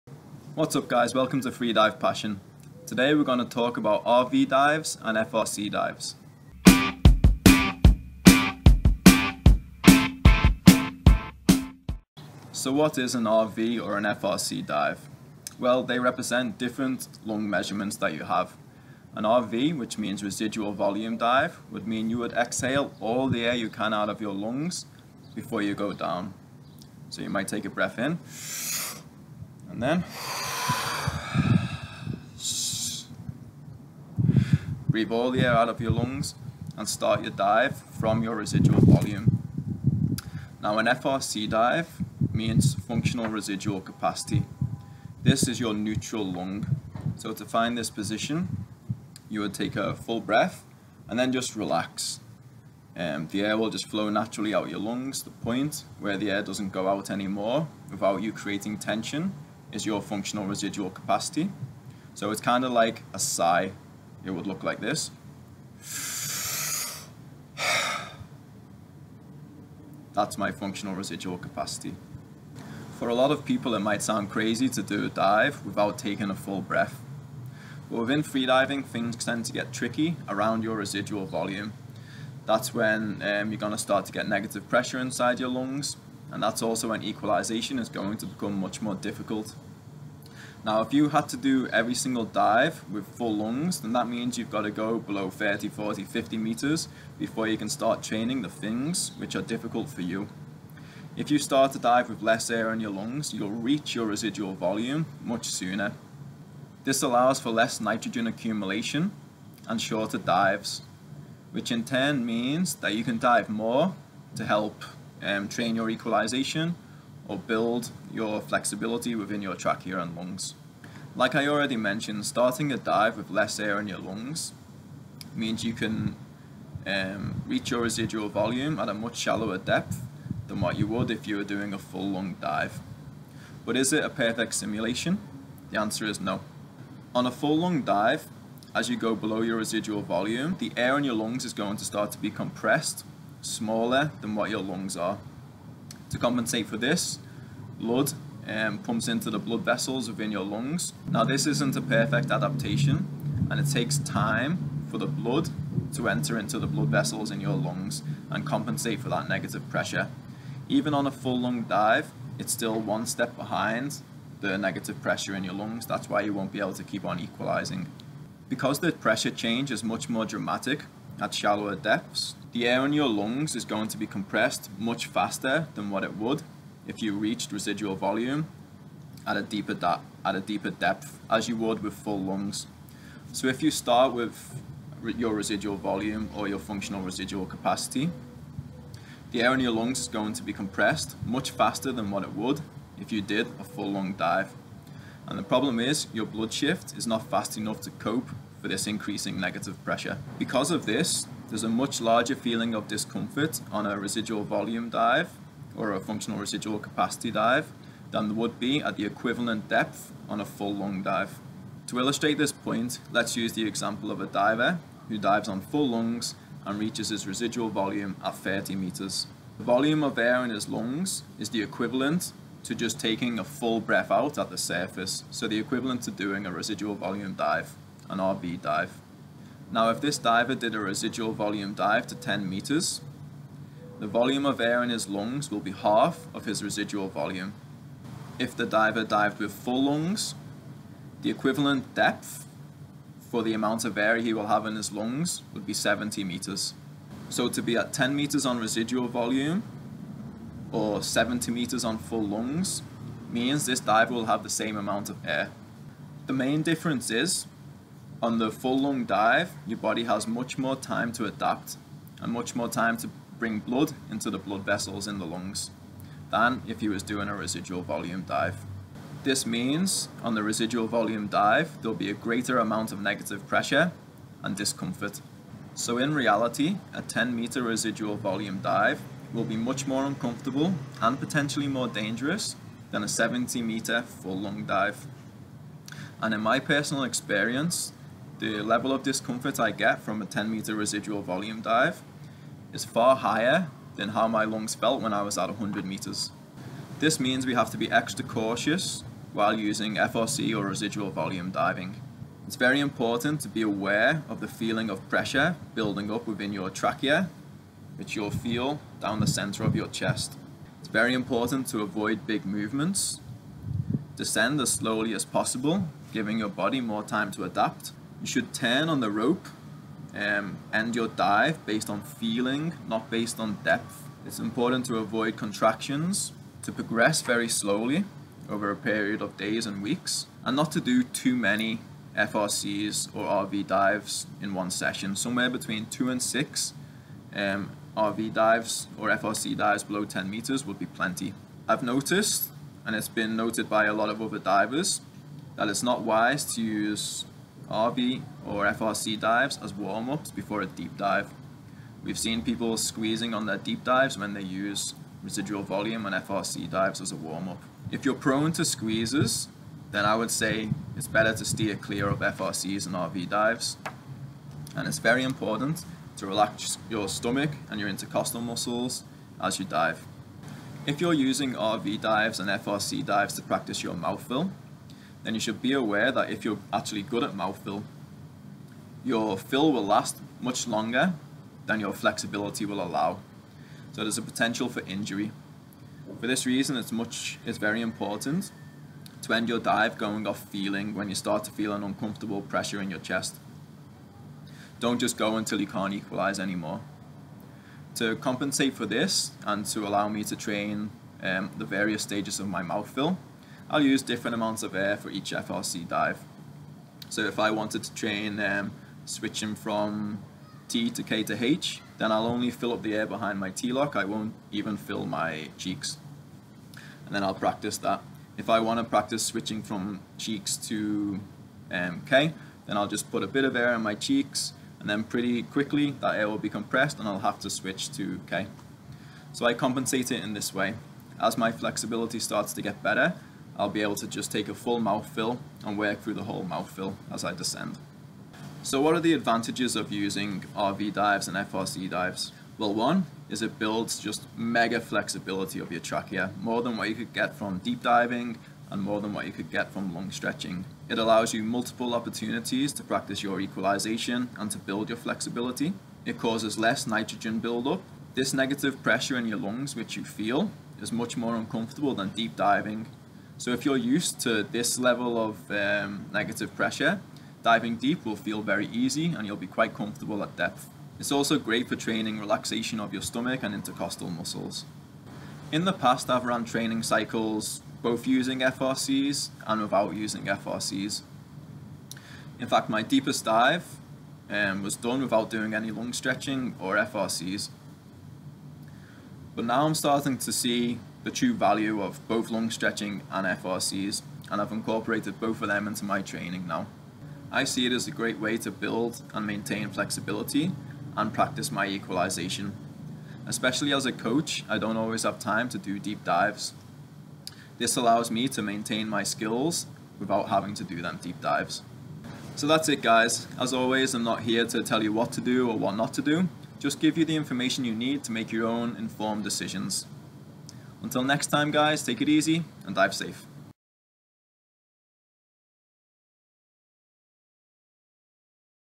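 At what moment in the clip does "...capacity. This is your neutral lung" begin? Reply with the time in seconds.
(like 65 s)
43 s.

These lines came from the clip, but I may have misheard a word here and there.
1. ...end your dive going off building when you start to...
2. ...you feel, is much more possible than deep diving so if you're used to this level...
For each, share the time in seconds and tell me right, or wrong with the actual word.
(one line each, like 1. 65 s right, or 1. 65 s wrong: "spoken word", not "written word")
1. 389 s wrong: "feeling", not "building"
2. 459 s wrong: "uncomfortable", not "possible".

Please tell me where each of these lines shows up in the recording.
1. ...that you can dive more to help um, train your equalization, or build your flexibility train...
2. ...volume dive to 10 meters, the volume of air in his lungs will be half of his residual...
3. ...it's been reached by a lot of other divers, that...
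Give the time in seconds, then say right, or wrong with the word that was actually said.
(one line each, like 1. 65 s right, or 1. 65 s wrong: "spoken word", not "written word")
1. 112 s wrong: "within", not "train"
2. 231 s right
3. 342 s wrong: "noted", not "reached".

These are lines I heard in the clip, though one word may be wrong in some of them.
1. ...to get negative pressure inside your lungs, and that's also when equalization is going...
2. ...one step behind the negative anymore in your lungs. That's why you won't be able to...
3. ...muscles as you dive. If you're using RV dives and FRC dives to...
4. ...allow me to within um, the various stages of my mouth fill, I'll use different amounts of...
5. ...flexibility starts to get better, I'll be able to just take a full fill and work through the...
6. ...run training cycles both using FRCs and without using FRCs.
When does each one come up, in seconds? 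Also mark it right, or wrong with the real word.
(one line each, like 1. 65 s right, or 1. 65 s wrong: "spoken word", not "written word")
1. 84 s right
2. 162 s wrong: "pressure", not "anymore"
3. 368 s right
4. 399 s wrong: "train", not "within"
5. 431 s right
6. 476 s right.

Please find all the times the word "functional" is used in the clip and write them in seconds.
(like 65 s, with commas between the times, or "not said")
42 s, 60 s, 70 s, 186 s, 205 s.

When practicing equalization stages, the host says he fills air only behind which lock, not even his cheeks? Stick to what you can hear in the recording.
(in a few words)
T-lock.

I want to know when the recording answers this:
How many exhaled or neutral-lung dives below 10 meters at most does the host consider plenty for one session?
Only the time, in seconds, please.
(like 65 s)
336 s.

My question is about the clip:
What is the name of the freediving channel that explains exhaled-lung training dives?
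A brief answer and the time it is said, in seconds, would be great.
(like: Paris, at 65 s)
Freedive Passion, at 1 s.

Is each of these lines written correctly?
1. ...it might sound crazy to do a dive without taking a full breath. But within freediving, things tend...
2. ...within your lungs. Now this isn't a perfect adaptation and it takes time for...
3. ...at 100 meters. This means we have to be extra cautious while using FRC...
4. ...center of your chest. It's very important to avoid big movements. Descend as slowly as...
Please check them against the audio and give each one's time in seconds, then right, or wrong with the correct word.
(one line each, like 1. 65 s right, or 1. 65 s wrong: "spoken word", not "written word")
1. 73 s right
2. 150 s right
3. 295 s right
4. 309 s right.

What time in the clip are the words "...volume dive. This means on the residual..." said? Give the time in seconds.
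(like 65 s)
267 s.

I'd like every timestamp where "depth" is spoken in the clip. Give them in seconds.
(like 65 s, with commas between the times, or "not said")
129 s, 171 s, 180 s, 209 s, 241 s, 323 s, 470 s.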